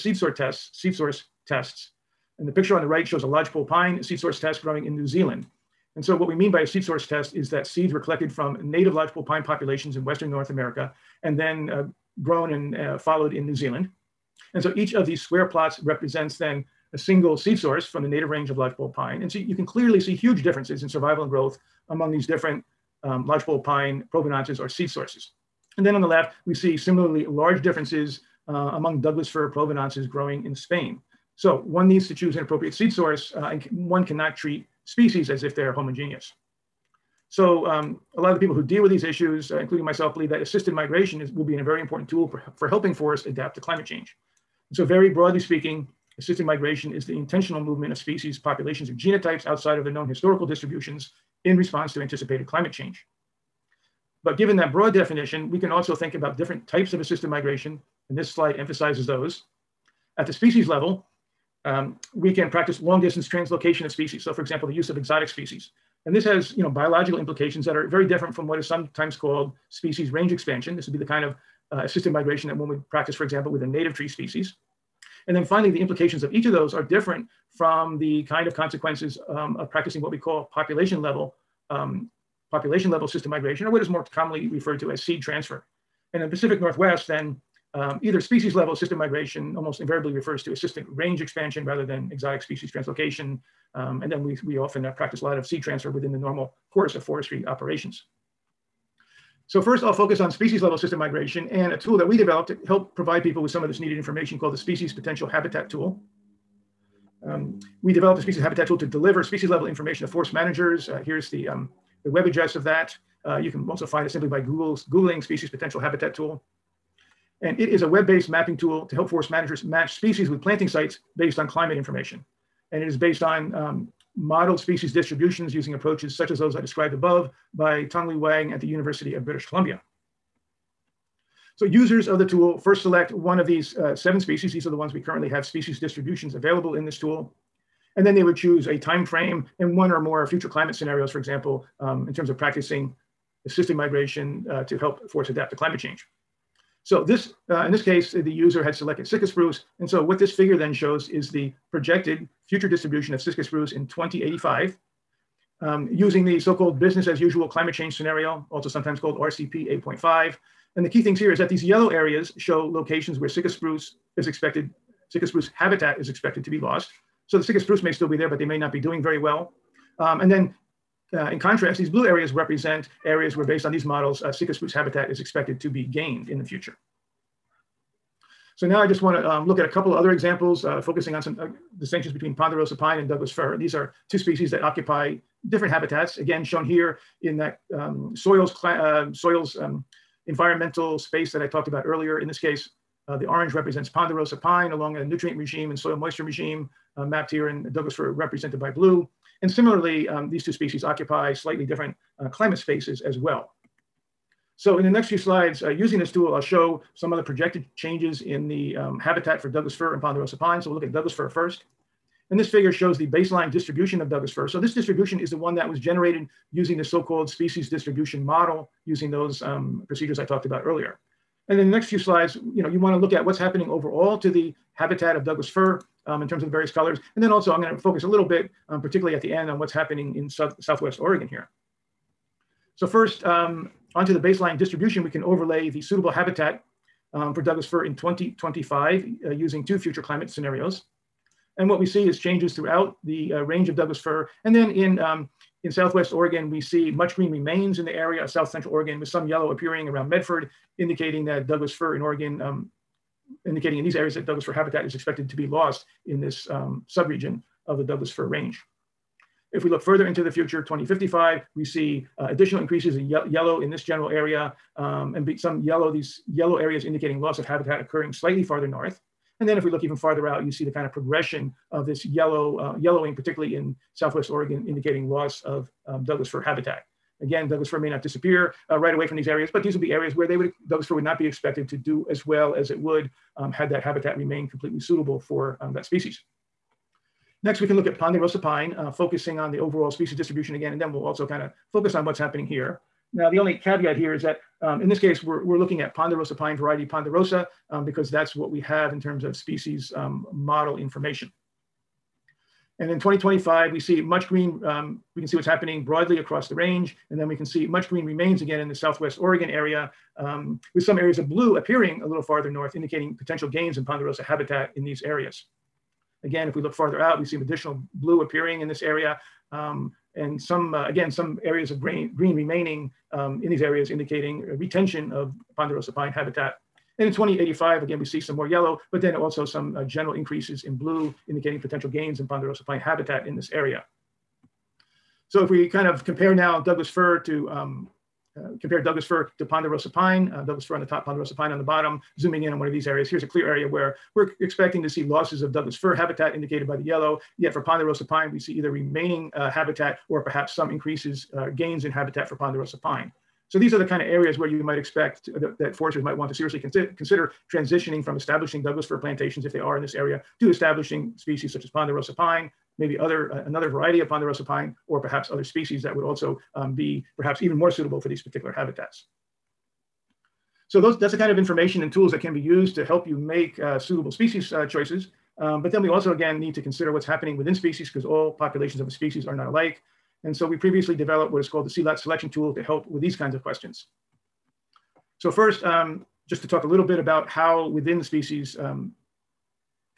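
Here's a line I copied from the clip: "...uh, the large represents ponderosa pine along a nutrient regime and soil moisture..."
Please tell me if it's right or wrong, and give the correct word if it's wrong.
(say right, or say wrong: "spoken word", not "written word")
wrong: "orange", not "large".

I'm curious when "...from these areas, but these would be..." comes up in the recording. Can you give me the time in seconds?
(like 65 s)
279 s.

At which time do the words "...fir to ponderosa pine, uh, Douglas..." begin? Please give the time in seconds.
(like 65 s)
339 s.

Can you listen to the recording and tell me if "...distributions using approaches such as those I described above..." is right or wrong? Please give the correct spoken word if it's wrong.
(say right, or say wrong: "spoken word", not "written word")
right.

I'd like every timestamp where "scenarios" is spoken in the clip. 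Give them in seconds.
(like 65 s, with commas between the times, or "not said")
140 s, 157 s, 240 s.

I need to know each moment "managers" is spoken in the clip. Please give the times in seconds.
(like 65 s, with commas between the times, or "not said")
110 s, 119 s.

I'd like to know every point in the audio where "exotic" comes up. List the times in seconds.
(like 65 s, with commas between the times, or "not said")
64 s, 92 s.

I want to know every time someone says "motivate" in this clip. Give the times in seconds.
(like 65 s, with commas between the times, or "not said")
not said.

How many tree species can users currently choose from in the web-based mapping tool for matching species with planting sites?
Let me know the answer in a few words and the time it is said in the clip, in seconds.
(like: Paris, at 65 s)
7, at 133 s.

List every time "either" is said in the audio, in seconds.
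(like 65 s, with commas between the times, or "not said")
88 s, 348 s.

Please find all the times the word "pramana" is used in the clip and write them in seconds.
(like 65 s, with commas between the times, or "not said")
not said.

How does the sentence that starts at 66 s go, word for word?
And this has you know, biological implications that are very different from what is sometimes called species range expansion.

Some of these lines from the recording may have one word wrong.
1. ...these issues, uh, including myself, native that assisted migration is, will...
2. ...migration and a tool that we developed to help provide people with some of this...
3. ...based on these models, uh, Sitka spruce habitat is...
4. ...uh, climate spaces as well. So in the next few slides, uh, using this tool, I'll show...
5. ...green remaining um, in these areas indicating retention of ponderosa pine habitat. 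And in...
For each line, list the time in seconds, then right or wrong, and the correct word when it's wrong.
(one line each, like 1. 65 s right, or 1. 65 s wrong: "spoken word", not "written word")
1. 38 s wrong: "believe", not "native"
2. 100 s right
3. 173 s right
4. 202 s right
5. 322 s right.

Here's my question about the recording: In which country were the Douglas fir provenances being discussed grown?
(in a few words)
Spain.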